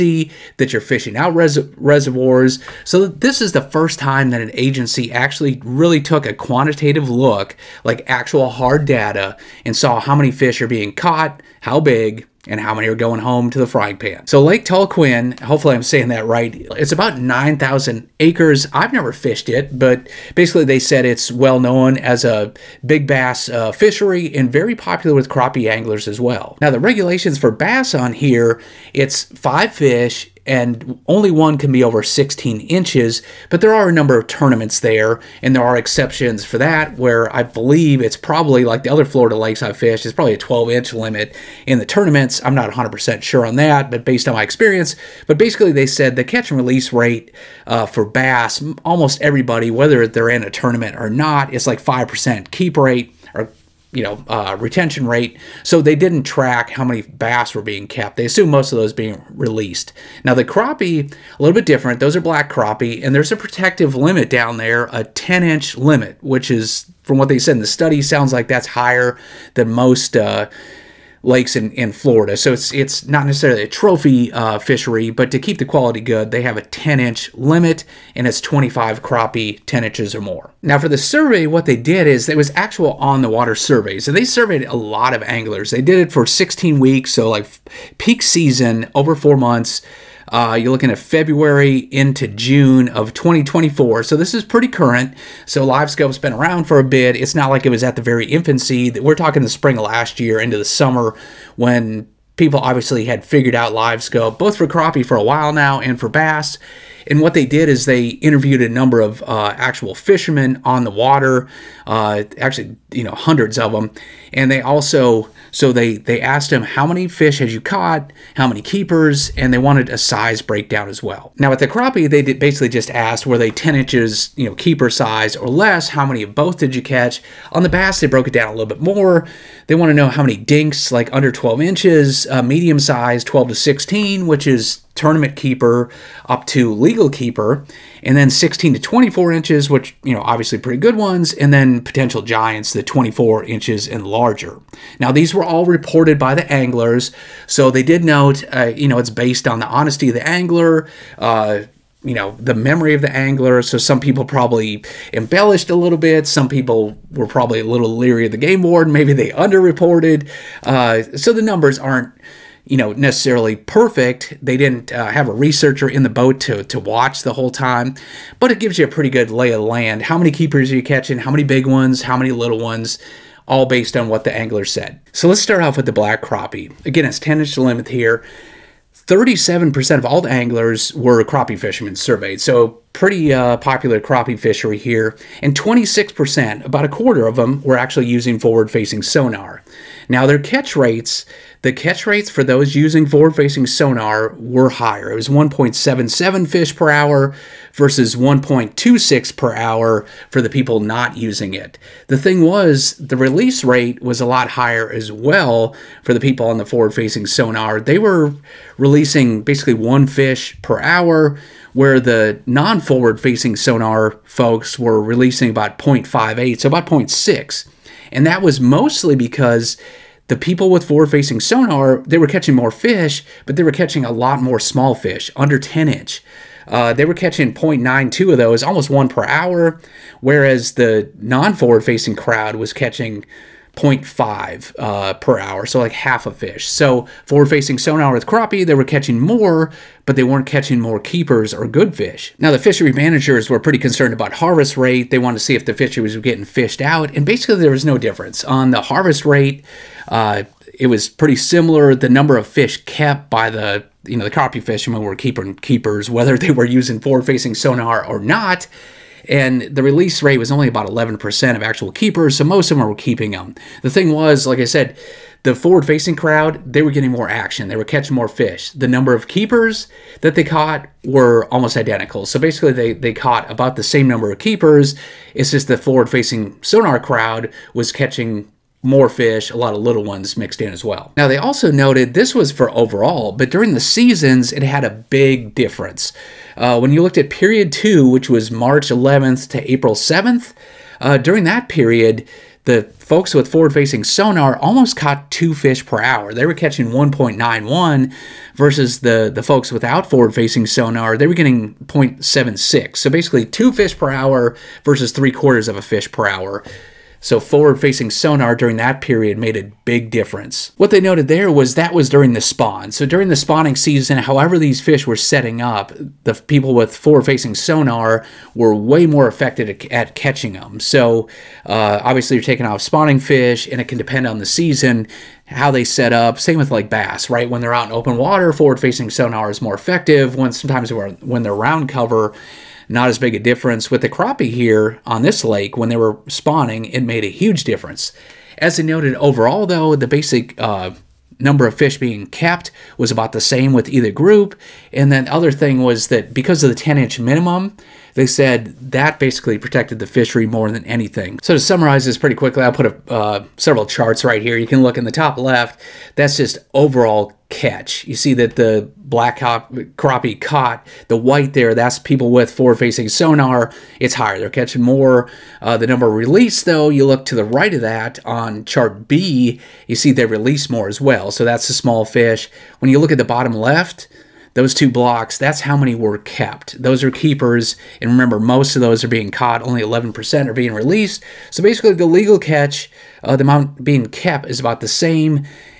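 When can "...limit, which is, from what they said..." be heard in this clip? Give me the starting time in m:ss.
1:05.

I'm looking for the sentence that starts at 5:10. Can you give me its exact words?
What they noted there was that was during the spawn.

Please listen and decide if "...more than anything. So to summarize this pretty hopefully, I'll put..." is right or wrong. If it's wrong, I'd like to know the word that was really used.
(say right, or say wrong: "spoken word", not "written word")
wrong: "quickly", not "hopefully".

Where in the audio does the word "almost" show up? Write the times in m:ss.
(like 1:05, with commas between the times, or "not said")
0:48, 3:48, 4:31, 4:54.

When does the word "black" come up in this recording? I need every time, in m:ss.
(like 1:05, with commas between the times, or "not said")
1:02, 2:55, 5:58.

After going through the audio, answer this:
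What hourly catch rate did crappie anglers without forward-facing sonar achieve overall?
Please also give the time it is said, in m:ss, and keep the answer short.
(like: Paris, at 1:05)
1.26 per hour, at 3:18.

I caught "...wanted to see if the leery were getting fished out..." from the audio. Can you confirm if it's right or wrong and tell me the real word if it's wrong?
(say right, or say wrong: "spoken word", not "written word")
wrong: "fishery", not "leery".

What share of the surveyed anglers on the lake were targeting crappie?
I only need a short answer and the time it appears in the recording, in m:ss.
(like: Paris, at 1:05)
37%, at 2:58.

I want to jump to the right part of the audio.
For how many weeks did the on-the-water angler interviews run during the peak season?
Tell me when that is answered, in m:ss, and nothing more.
1:26.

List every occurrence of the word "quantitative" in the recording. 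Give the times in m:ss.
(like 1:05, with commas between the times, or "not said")
0:06.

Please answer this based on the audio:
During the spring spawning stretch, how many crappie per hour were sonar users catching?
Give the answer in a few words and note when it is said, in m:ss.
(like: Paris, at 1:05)
1.91, at 4:56.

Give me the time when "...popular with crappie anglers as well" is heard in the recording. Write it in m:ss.
0:24.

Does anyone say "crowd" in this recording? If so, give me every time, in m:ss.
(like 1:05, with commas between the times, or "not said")
3:52, 4:26, 4:36.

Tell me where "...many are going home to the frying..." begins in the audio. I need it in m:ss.
0:12.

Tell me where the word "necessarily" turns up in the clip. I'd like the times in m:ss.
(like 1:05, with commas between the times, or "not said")
1:13, 2:42.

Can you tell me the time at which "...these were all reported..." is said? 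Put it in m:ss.
2:25.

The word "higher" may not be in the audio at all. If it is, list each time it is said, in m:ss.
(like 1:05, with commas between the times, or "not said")
1:08, 3:14, 3:24, 6:04.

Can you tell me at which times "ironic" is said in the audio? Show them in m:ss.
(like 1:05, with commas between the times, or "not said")
not said.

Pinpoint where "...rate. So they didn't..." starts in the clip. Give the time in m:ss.
0:55.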